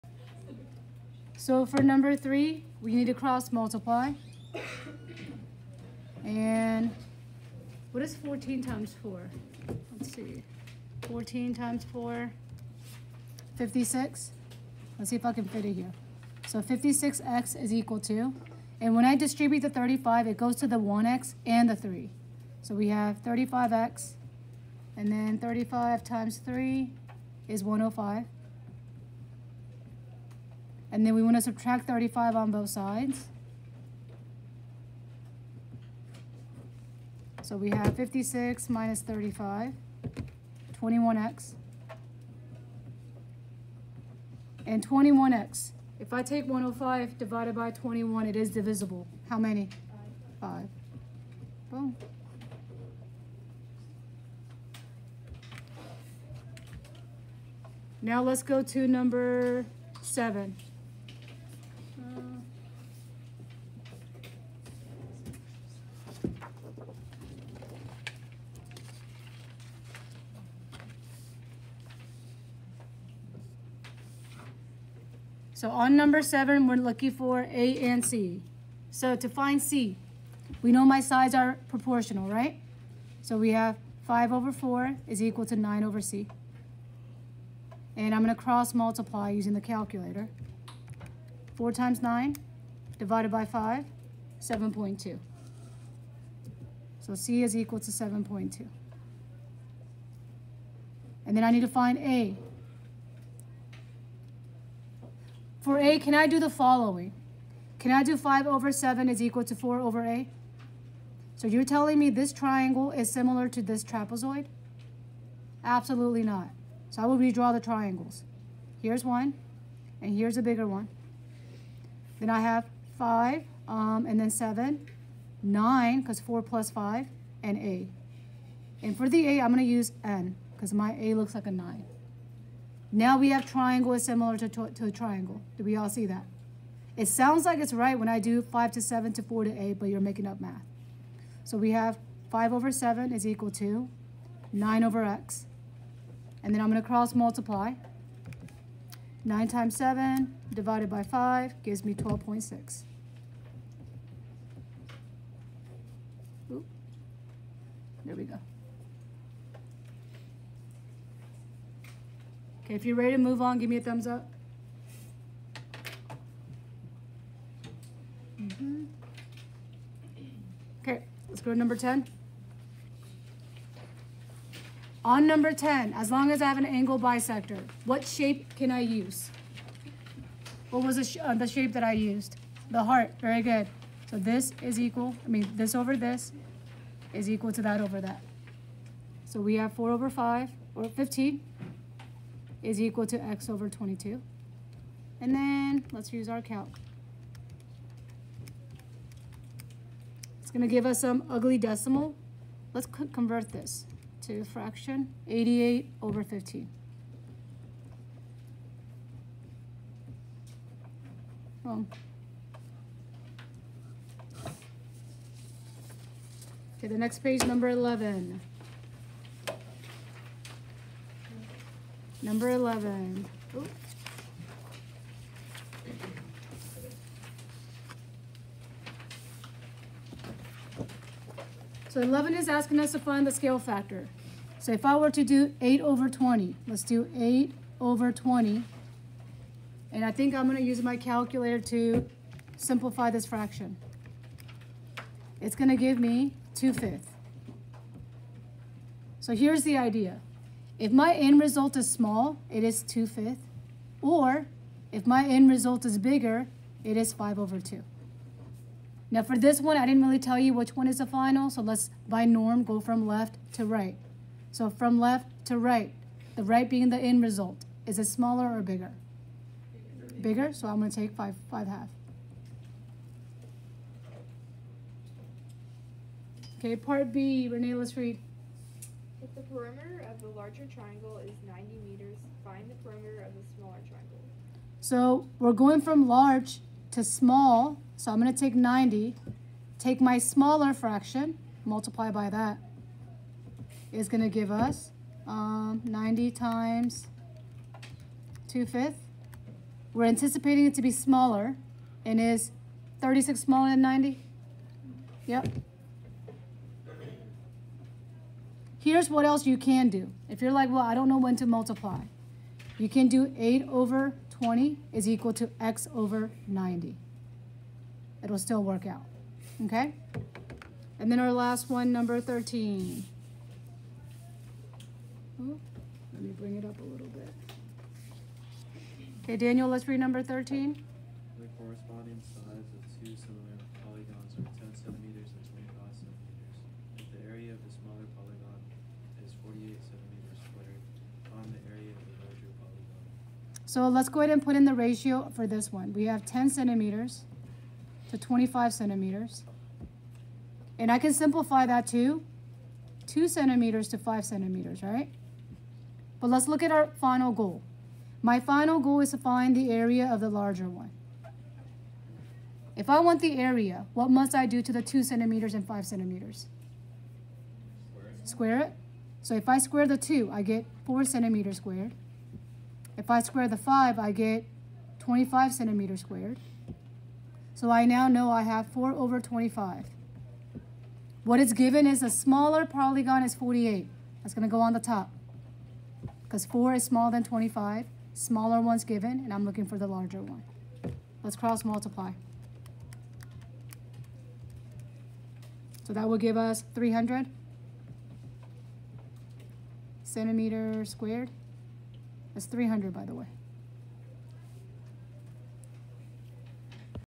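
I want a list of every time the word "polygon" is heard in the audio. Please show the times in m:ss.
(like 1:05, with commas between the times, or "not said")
5:33, 5:42, 6:22.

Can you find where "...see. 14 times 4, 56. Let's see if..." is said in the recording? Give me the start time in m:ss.
0:10.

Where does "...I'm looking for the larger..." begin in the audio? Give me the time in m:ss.
6:29.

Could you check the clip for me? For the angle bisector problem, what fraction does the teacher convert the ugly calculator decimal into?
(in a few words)
88/15.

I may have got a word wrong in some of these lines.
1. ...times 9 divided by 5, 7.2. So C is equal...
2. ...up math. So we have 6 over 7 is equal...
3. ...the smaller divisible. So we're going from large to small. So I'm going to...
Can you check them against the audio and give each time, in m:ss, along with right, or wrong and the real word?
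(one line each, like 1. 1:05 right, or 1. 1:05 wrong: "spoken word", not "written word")
1. 1:31 right
2. 2:20 wrong: "5", not "6"
3. 4:43 wrong: "triangle", not "divisible".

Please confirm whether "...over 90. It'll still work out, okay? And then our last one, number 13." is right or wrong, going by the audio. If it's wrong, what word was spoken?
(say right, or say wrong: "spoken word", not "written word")
right.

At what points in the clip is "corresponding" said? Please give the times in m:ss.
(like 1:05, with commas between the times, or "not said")
5:31.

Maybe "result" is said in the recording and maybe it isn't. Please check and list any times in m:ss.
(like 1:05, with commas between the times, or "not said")
4:11, 4:15, 4:27.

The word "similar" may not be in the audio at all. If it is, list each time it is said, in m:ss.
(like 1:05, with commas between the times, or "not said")
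1:53, 2:14, 5:33.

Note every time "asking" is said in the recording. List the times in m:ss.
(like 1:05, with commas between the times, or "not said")
3:52.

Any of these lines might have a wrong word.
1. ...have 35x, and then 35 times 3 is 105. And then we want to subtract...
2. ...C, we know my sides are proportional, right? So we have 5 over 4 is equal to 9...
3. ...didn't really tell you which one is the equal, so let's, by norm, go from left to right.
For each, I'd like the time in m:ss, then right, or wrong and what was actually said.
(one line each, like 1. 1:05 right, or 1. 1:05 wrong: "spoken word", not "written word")
1. 0:22 right
2. 1:19 right
3. 4:19 wrong: "final", not "equal".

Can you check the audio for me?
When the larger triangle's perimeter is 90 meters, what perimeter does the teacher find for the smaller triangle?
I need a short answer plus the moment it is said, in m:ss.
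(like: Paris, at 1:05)
36, at 5:03.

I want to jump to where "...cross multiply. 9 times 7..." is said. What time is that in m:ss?
2:26.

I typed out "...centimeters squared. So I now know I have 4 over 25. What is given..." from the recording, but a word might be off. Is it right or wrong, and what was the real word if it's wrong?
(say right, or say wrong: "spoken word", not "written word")
right.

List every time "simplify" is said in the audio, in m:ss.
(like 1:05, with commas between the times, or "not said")
4:02, 5:51.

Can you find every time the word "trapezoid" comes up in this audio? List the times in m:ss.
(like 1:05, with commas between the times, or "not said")
1:53.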